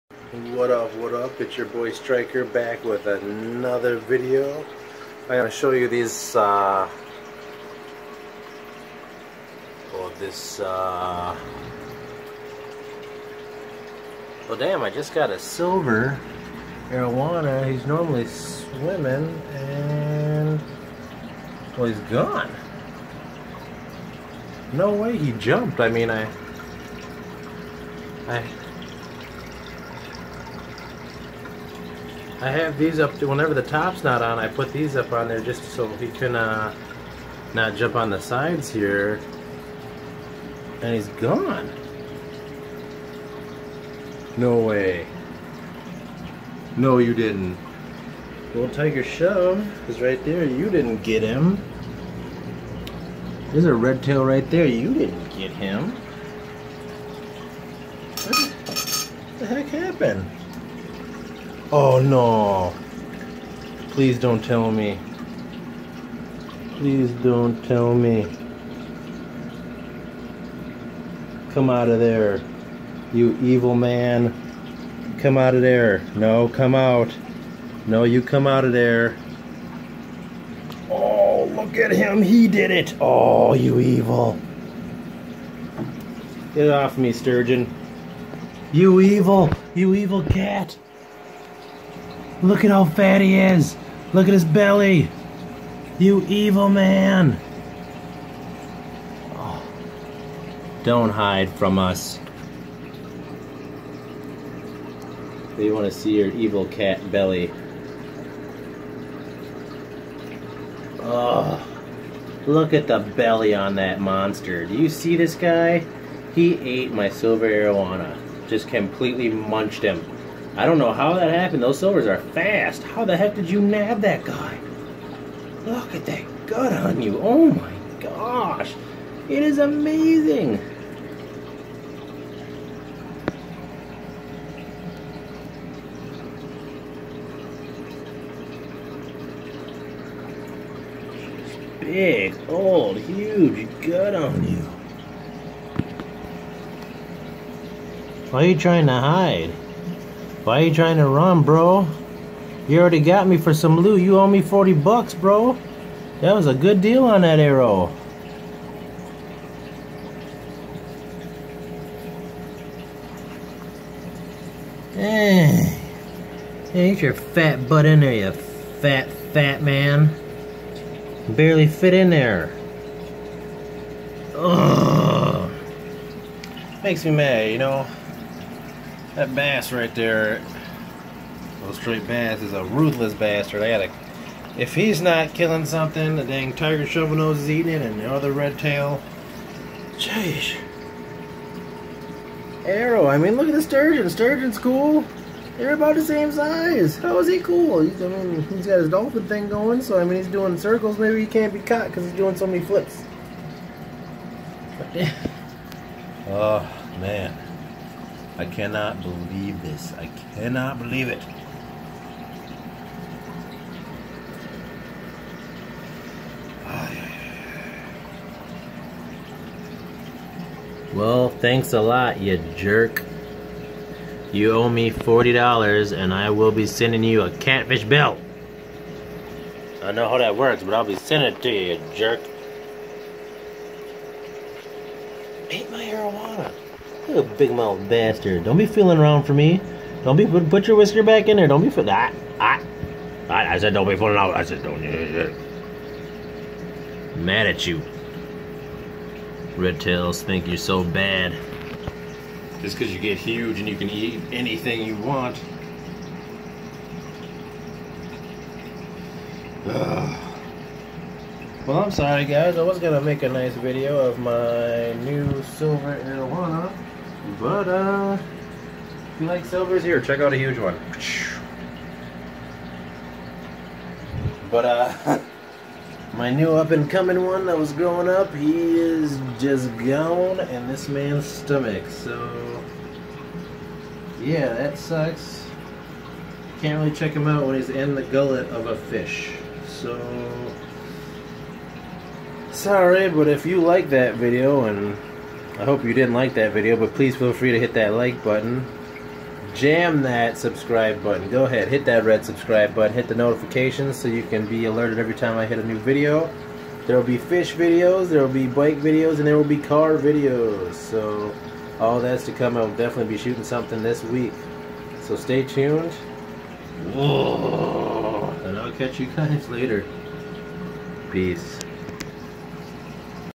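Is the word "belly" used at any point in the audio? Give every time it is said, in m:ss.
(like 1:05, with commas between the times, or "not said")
1:34, 1:47, 1:53.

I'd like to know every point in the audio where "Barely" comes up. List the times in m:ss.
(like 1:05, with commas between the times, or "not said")
2:51.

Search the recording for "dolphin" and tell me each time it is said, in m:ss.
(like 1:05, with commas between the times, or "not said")
3:18.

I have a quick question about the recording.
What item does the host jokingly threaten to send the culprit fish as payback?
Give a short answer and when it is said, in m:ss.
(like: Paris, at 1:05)
A catfish belt, at 3:47.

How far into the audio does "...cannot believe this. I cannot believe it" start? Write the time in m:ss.
3:28.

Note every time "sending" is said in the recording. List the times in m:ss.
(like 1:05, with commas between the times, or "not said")
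3:46, 3:50.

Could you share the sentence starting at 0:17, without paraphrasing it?
He's normally swimming, and, well, he's gone.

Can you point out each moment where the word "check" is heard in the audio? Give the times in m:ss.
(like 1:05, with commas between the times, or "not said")
4:30, 4:46.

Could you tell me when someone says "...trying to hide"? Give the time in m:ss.
2:28.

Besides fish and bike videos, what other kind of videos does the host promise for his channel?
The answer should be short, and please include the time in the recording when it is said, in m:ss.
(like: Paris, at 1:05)
Car videos, at 5:09.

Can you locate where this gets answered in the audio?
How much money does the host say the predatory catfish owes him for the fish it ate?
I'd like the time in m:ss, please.
2:34.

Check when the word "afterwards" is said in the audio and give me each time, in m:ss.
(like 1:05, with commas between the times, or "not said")
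not said.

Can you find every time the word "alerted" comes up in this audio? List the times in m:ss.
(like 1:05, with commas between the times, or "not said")
5:04.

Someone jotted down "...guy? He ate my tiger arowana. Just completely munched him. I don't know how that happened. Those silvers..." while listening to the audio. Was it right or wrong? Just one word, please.
wrong.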